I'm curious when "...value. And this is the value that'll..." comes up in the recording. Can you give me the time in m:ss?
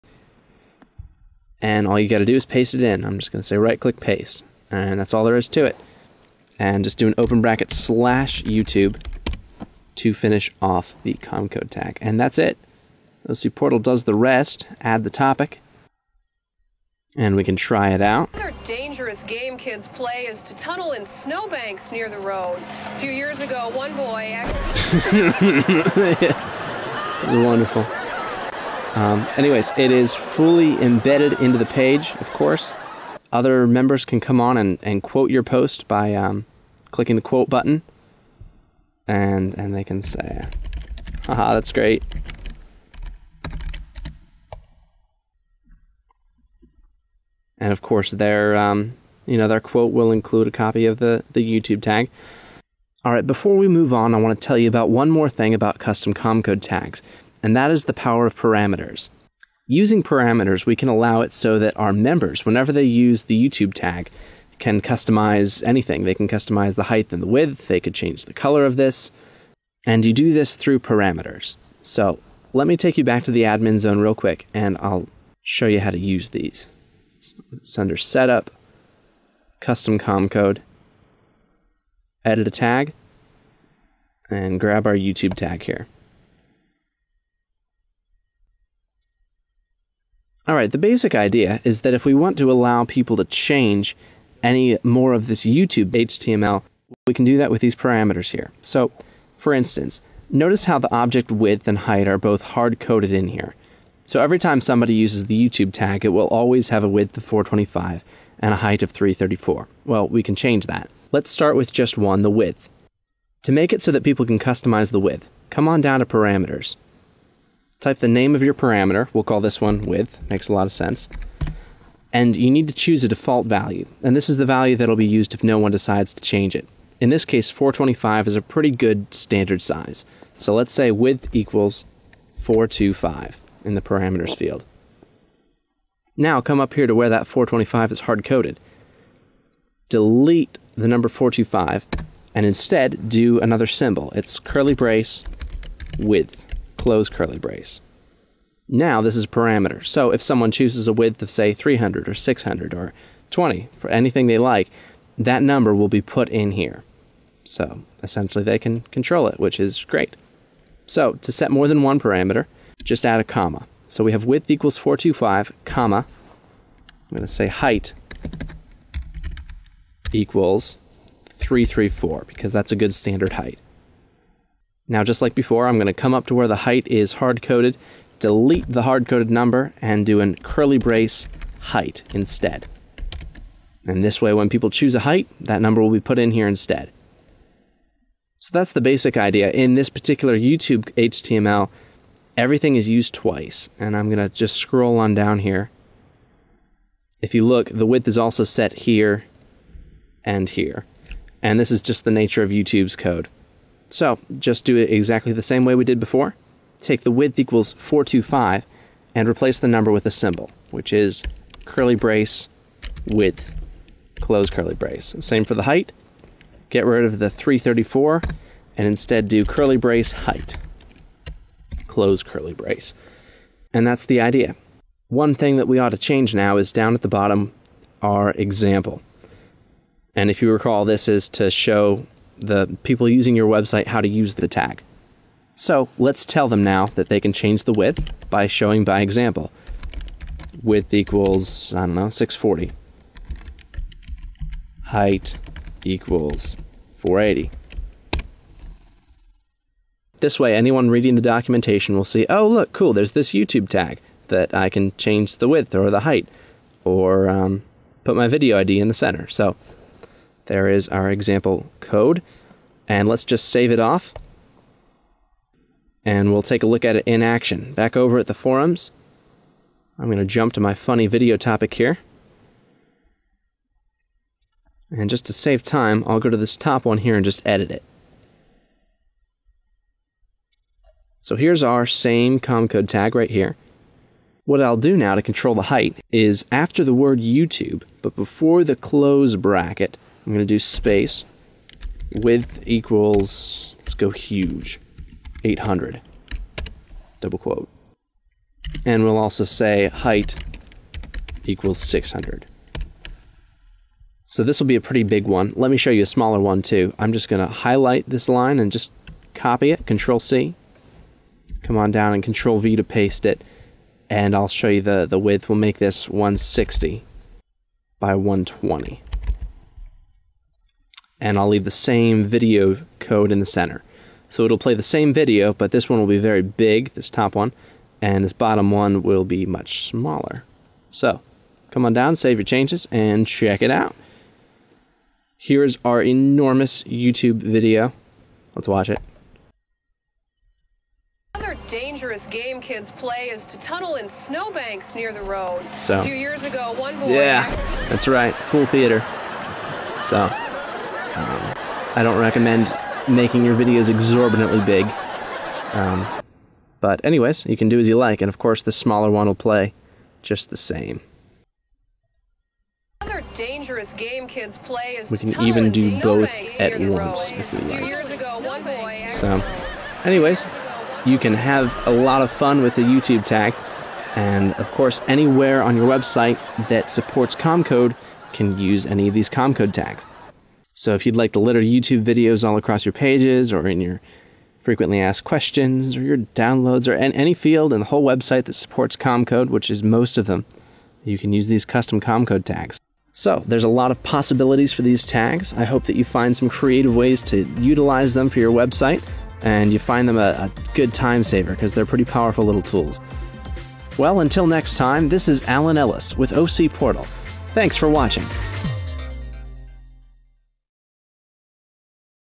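2:03.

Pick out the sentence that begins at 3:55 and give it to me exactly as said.
So let's tell them now that they can change the width by showing by example.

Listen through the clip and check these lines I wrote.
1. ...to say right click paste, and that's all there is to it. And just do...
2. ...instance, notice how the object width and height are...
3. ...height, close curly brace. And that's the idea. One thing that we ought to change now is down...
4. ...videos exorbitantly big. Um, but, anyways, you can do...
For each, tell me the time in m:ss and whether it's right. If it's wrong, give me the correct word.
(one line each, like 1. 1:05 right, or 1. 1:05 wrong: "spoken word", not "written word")
1. 0:03 right
2. 1:39 right
3. 3:40 right
4. 5:53 right.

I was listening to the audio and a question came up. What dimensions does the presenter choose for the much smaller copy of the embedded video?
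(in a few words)
160 by 120.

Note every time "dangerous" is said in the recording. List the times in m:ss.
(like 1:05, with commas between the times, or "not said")
0:18, 5:41, 6:03.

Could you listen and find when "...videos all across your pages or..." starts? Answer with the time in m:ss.
6:22.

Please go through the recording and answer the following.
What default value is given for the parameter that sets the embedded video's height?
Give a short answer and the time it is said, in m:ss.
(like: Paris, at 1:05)
334, at 2:46.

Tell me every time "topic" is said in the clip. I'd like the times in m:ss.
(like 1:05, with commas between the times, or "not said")
0:15, 4:31.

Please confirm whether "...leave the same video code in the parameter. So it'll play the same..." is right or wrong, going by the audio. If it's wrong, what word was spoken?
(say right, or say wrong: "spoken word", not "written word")
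wrong: "center", not "parameter".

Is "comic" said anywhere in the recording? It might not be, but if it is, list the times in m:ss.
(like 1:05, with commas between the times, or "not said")
not said.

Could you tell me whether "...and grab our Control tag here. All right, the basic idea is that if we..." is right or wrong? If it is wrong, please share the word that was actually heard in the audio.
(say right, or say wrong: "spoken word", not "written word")
wrong: "YouTube", not "Control".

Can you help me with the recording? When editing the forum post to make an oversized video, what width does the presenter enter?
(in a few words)
800.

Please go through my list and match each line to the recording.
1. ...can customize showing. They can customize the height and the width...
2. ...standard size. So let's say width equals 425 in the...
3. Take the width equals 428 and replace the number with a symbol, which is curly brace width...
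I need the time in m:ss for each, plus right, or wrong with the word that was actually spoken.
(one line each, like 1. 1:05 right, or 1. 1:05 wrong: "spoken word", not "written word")
1. 1:04 wrong: "anything", not "showing"
2. 2:09 right
3. 3:26 wrong: "425", not "428".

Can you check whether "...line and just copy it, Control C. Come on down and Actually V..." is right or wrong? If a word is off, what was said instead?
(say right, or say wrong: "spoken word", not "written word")
wrong: "Control", not "Actually".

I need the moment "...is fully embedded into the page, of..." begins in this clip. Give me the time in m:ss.
0:29.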